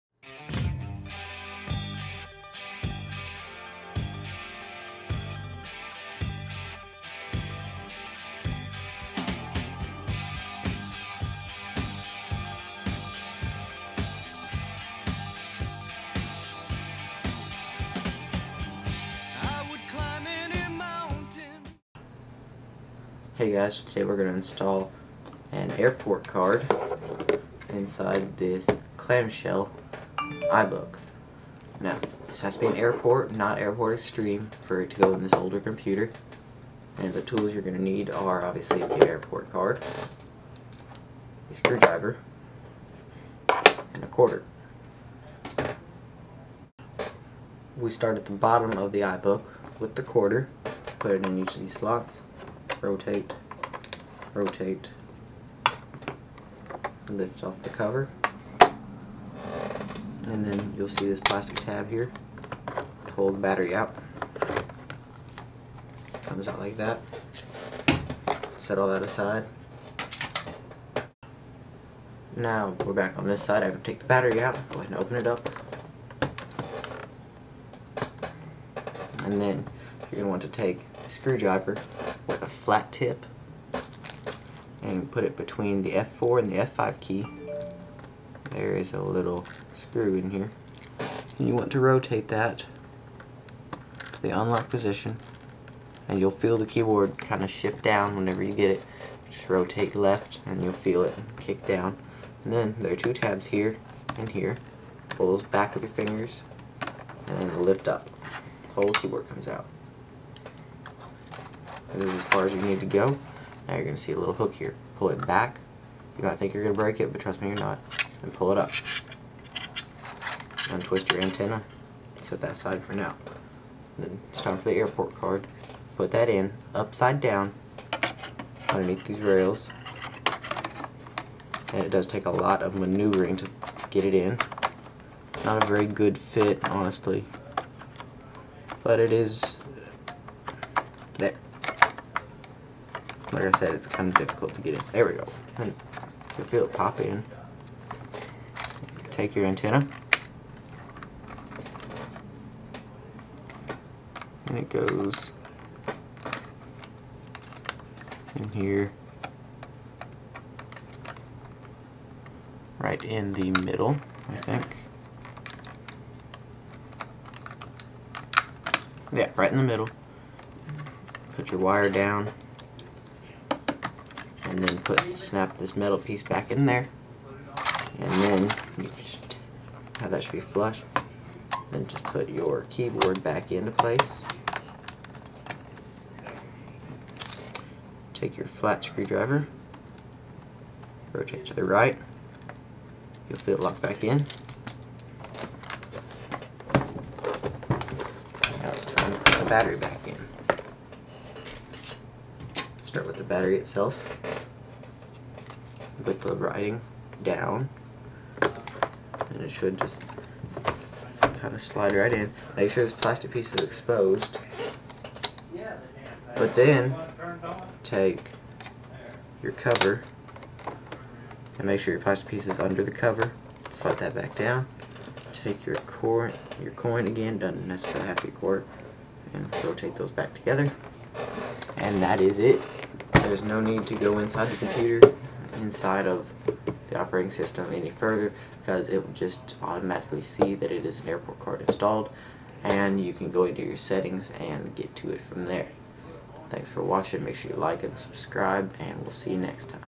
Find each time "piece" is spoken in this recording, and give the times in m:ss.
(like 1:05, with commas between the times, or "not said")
2:55, 3:33, 3:42.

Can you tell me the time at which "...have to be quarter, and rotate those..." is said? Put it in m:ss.
3:48.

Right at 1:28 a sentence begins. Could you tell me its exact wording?
There is a little screw in here.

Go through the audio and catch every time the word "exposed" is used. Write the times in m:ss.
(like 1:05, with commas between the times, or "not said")
3:33.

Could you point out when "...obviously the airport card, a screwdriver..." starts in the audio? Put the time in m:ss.
0:38.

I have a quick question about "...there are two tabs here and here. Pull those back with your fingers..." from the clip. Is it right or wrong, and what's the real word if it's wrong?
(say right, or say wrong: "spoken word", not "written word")
right.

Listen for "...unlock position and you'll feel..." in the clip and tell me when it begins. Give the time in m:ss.
1:34.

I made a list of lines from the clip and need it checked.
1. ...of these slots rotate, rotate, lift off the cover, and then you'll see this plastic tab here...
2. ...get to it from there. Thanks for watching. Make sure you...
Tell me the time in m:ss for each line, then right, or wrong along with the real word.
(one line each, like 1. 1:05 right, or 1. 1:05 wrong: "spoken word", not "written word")
1. 0:51 right
2. 4:04 right.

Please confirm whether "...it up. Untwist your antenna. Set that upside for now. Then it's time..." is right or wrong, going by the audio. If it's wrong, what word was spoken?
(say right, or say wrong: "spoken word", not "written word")
wrong: "aside", not "upside".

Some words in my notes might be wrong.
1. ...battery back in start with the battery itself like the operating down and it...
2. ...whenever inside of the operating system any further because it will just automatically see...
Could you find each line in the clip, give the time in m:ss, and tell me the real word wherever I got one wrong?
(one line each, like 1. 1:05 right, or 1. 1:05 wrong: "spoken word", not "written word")
1. 3:19 wrong: "writing", not "operating"
2. 3:54 wrong: "computer", not "whenever".